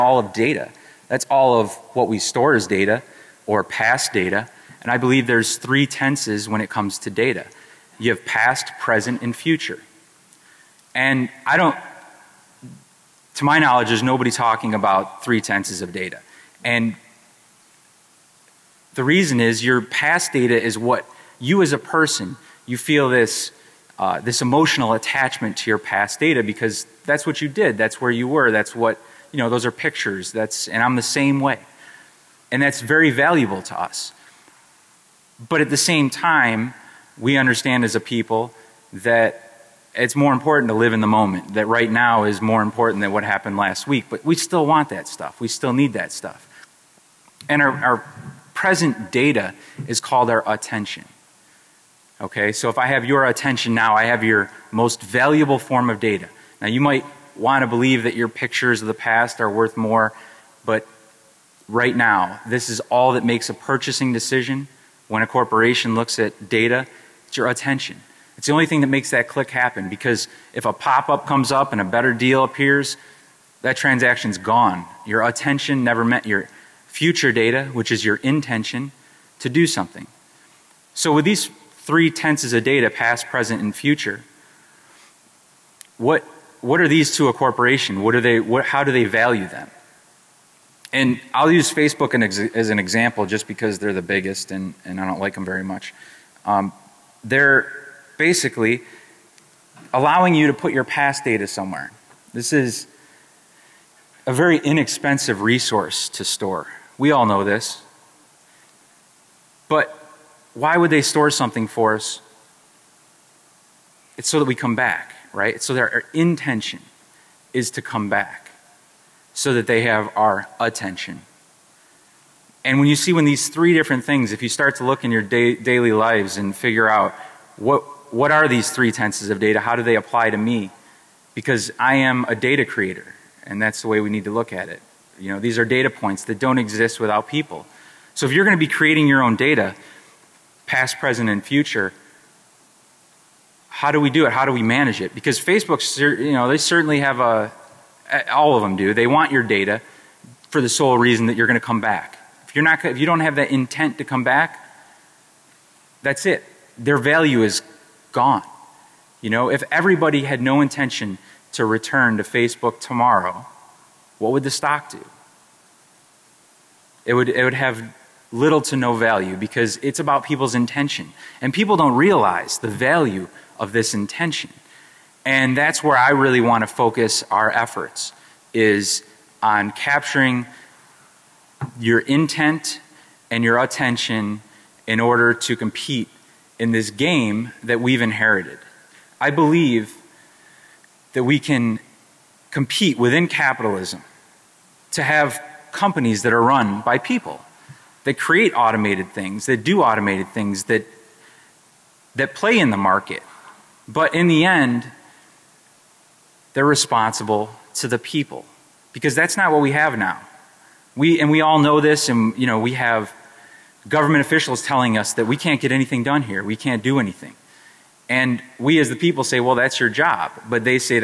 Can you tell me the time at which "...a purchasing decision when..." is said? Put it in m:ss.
1:03.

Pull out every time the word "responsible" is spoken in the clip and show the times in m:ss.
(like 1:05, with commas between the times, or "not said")
3:26.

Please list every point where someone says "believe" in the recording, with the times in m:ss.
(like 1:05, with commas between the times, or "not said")
0:04, 0:57, 3:09.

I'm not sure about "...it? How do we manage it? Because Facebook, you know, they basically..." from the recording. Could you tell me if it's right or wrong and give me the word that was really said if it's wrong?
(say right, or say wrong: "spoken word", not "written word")
wrong: "certainly", not "basically".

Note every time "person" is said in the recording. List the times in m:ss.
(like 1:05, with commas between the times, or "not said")
0:21.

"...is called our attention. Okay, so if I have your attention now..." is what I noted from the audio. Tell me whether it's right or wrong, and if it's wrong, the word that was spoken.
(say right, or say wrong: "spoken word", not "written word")
right.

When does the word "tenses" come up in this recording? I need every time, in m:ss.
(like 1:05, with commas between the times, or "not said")
0:05, 0:15, 1:22, 2:08.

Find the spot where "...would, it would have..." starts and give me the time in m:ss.
2:47.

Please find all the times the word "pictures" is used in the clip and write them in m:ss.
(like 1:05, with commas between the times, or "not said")
0:29, 0:58.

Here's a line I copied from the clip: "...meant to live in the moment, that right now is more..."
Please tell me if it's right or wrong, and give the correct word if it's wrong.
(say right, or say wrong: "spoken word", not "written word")
wrong: "important", not "meant".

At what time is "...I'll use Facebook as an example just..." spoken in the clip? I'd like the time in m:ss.
1:31.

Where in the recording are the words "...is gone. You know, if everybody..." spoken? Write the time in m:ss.
2:37.